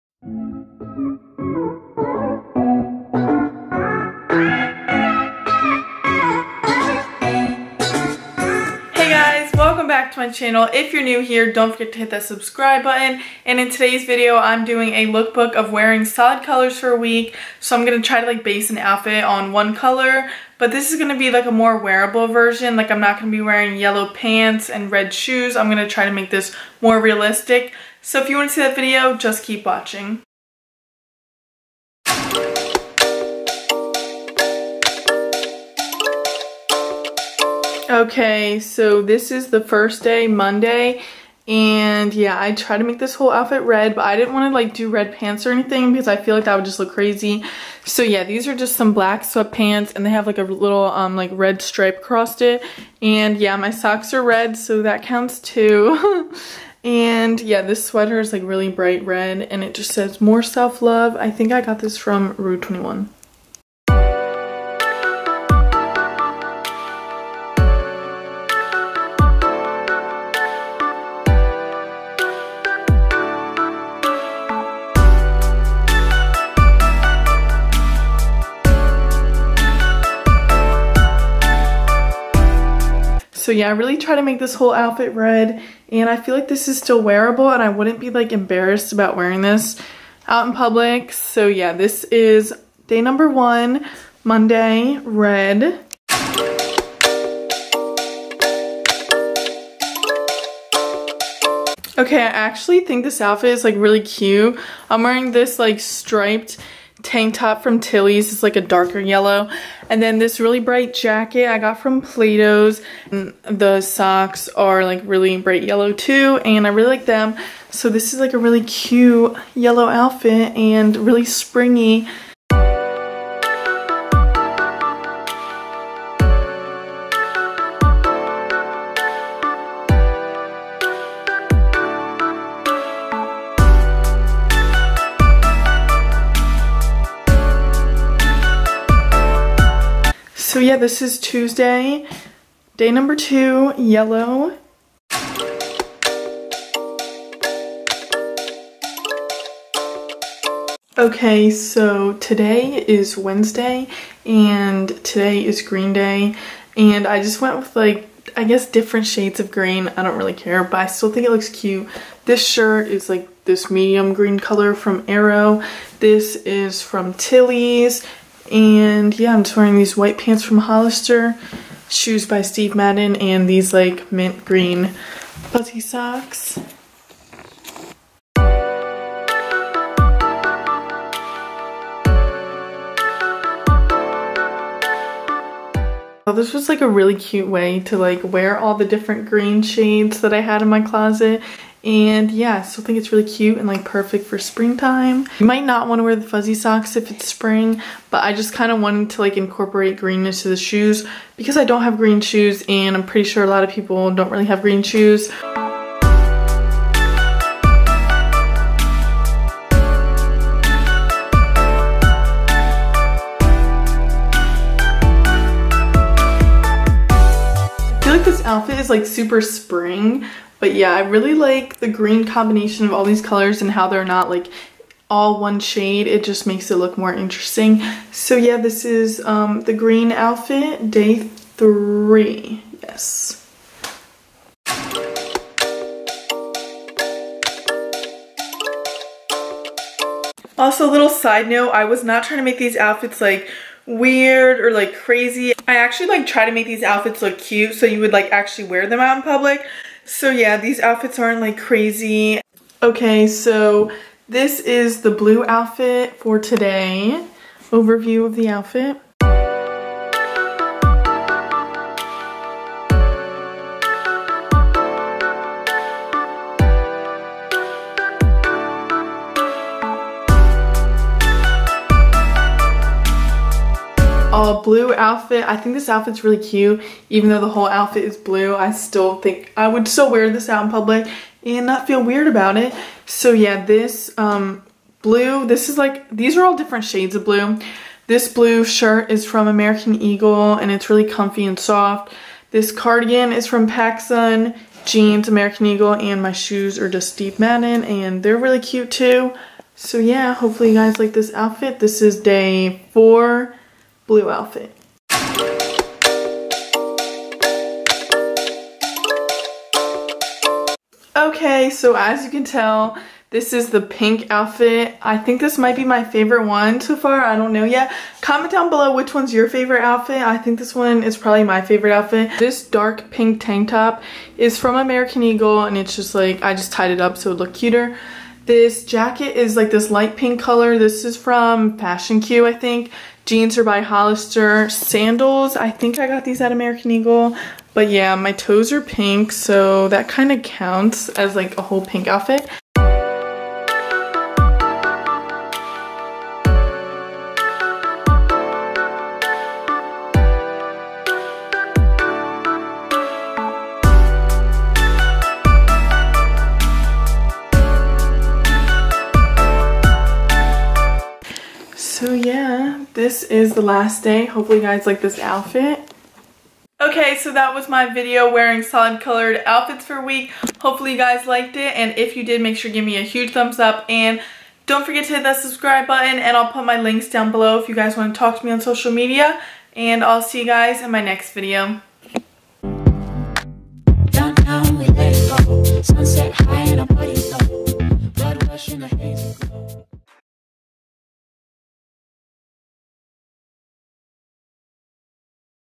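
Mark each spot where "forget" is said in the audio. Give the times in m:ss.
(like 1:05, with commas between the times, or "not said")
0:11, 6:14.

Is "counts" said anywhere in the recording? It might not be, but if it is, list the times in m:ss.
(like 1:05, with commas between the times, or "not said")
0:55, 5:40.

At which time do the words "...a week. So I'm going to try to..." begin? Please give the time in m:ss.
0:16.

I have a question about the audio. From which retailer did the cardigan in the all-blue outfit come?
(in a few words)
PacSun.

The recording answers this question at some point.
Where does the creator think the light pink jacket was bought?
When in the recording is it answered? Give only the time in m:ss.
5:31.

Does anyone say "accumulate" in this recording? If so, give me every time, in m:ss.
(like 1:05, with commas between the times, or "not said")
not said.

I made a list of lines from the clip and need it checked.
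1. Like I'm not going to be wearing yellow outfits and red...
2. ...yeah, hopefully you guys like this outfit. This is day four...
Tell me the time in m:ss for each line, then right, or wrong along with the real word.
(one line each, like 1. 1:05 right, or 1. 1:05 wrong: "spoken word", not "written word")
1. 0:22 wrong: "pants", not "outfits"
2. 4:59 right.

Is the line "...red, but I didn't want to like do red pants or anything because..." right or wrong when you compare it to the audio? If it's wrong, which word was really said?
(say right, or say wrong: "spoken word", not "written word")
right.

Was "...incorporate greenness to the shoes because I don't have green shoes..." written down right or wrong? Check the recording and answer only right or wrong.
right.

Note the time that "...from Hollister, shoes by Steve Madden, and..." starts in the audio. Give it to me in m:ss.
2:50.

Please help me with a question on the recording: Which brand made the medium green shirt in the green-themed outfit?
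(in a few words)
Aero.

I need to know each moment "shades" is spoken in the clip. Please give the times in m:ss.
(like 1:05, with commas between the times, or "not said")
2:39, 3:09, 3:45, 4:46.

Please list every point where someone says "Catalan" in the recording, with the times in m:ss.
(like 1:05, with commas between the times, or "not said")
not said.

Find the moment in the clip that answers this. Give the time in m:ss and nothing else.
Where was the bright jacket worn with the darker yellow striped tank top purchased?
1:52.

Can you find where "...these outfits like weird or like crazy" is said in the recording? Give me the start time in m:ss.
4:02.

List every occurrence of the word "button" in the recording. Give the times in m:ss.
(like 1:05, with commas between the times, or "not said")
0:12, 6:15.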